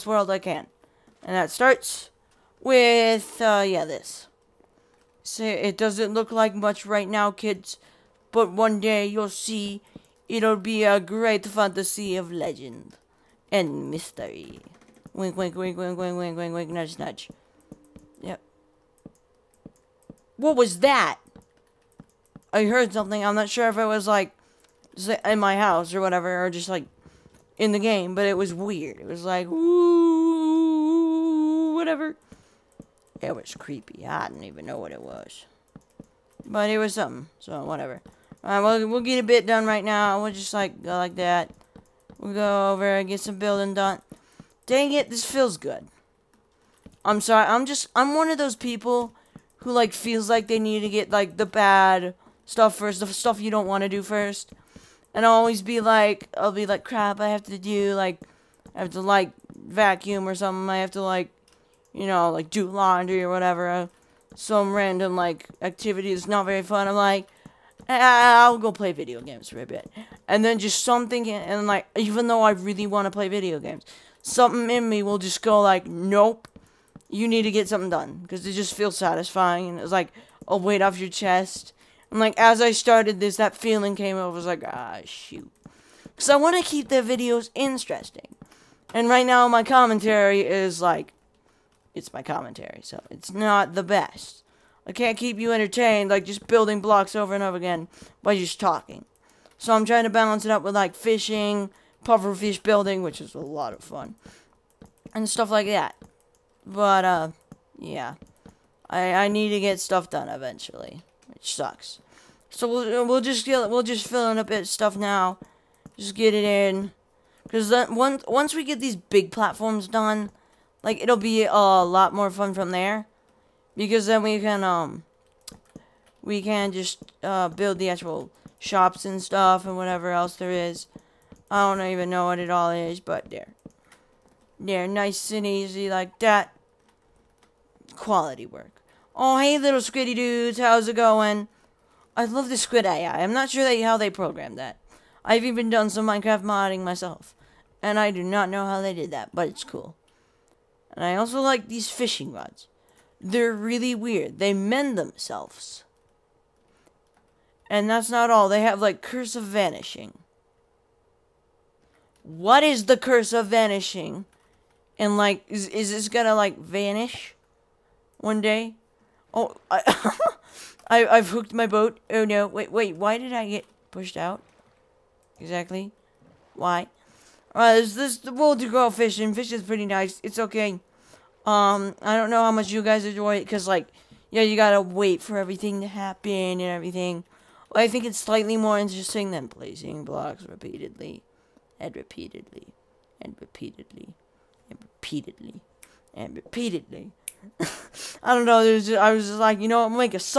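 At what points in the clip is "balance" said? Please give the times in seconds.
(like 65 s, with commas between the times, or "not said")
100 s.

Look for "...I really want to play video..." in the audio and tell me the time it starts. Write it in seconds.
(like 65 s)
72 s.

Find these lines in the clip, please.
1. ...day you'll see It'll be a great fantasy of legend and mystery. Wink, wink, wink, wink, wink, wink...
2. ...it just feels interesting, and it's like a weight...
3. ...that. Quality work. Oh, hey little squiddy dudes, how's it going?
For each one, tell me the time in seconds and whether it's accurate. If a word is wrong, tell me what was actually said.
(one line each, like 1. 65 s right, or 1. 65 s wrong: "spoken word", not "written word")
1. 8 s right
2. 78 s wrong: "satisfying", not "interesting"
3. 136 s right.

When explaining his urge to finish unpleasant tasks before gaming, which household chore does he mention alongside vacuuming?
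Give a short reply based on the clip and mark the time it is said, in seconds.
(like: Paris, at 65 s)
laundry, at 62 s.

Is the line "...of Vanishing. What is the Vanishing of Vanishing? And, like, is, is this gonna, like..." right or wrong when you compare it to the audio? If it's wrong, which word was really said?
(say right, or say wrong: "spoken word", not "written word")
wrong: "Curse", not "Vanishing".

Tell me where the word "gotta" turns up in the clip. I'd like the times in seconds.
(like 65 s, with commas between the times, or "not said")
184 s.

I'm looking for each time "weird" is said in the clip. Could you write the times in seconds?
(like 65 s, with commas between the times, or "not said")
28 s, 153 s.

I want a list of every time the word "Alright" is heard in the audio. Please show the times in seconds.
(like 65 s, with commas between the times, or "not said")
38 s, 177 s.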